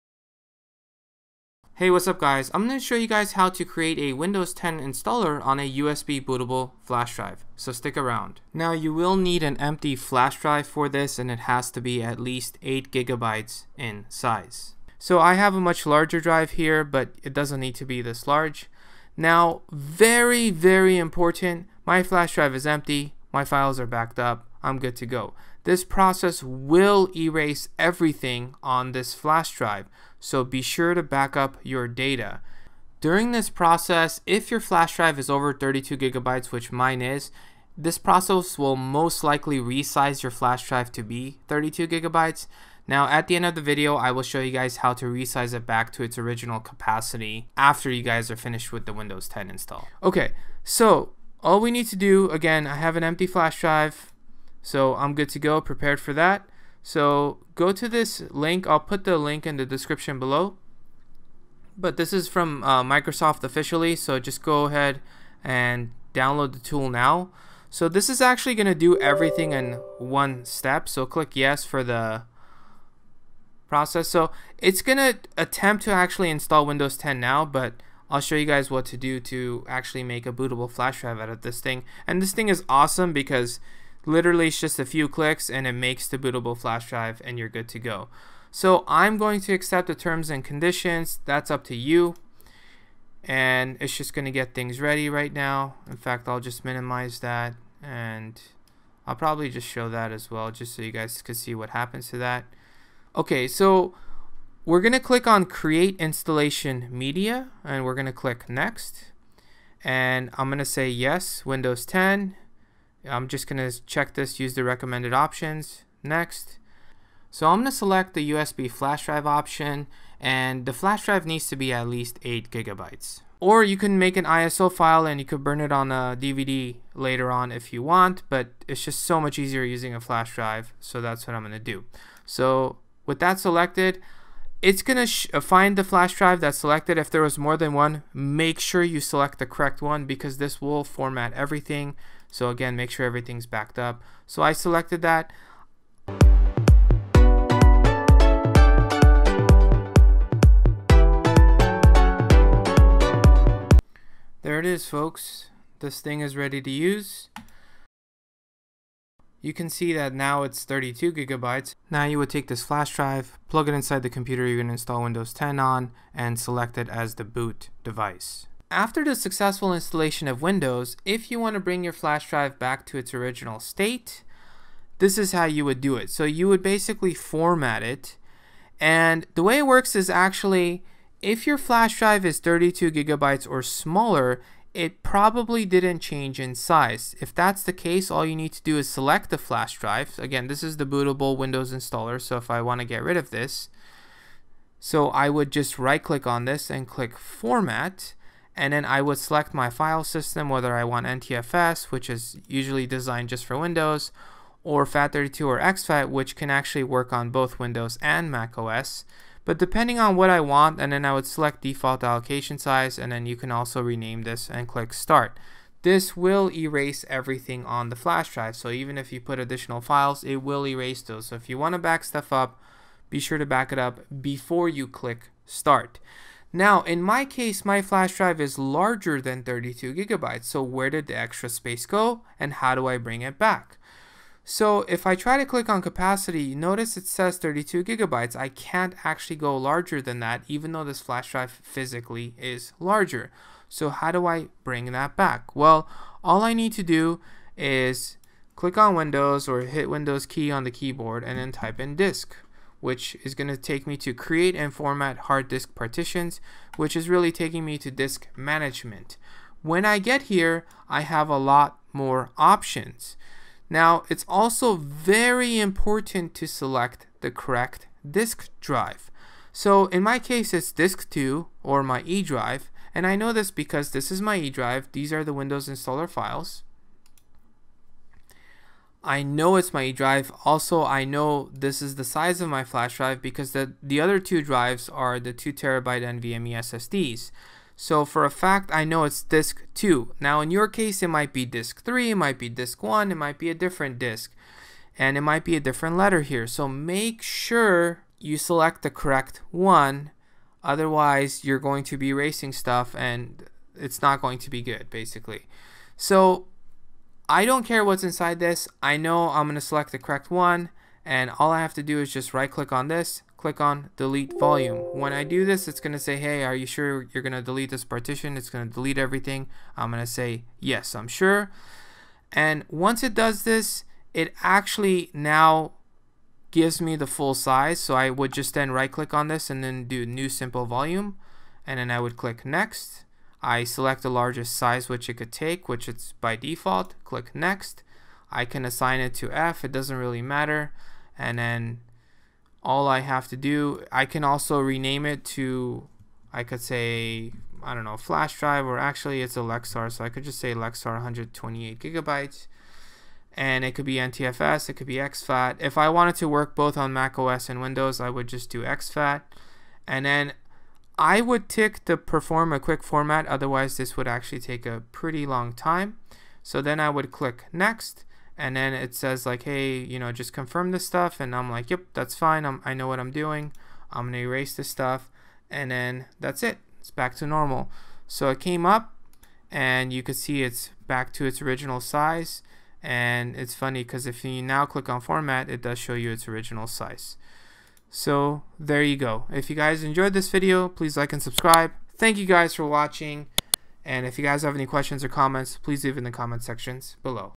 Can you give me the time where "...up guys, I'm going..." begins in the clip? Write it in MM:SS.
00:02.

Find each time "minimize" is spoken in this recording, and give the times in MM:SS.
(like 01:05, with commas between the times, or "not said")
01:36.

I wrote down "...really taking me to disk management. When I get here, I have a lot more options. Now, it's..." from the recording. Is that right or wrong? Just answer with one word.
right.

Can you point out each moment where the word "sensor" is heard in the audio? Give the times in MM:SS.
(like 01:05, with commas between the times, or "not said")
not said.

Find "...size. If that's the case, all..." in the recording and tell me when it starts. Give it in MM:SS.
03:06.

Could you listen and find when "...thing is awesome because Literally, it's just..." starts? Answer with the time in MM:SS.
01:22.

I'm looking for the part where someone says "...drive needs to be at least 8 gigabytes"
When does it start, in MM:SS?
02:01.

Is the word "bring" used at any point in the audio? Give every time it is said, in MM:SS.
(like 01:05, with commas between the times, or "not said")
02:51, 03:52, 04:04.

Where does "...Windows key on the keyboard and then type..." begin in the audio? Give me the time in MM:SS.
04:09.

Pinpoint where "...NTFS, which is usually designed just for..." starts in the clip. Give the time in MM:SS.
03:21.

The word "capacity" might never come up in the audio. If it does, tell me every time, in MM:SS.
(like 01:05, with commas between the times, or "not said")
00:46, 03:55.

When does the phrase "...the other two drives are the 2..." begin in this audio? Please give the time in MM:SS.
04:43.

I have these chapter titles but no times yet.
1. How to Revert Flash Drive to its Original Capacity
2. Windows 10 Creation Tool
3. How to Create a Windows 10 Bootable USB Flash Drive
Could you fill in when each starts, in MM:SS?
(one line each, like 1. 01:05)
1. 02:48
2. 00:56
3. 01:42.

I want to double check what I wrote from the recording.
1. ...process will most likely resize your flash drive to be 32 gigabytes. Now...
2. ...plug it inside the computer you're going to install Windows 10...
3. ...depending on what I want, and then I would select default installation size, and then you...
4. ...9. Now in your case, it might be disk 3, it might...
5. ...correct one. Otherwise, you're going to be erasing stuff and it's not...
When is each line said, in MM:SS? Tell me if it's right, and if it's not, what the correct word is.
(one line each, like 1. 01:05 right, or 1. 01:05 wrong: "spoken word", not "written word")
1. 00:37 right
2. 02:43 right
3. 03:29 wrong: "allocation", not "installation"
4. 04:49 wrong: "2", not "9"
5. 04:58 right.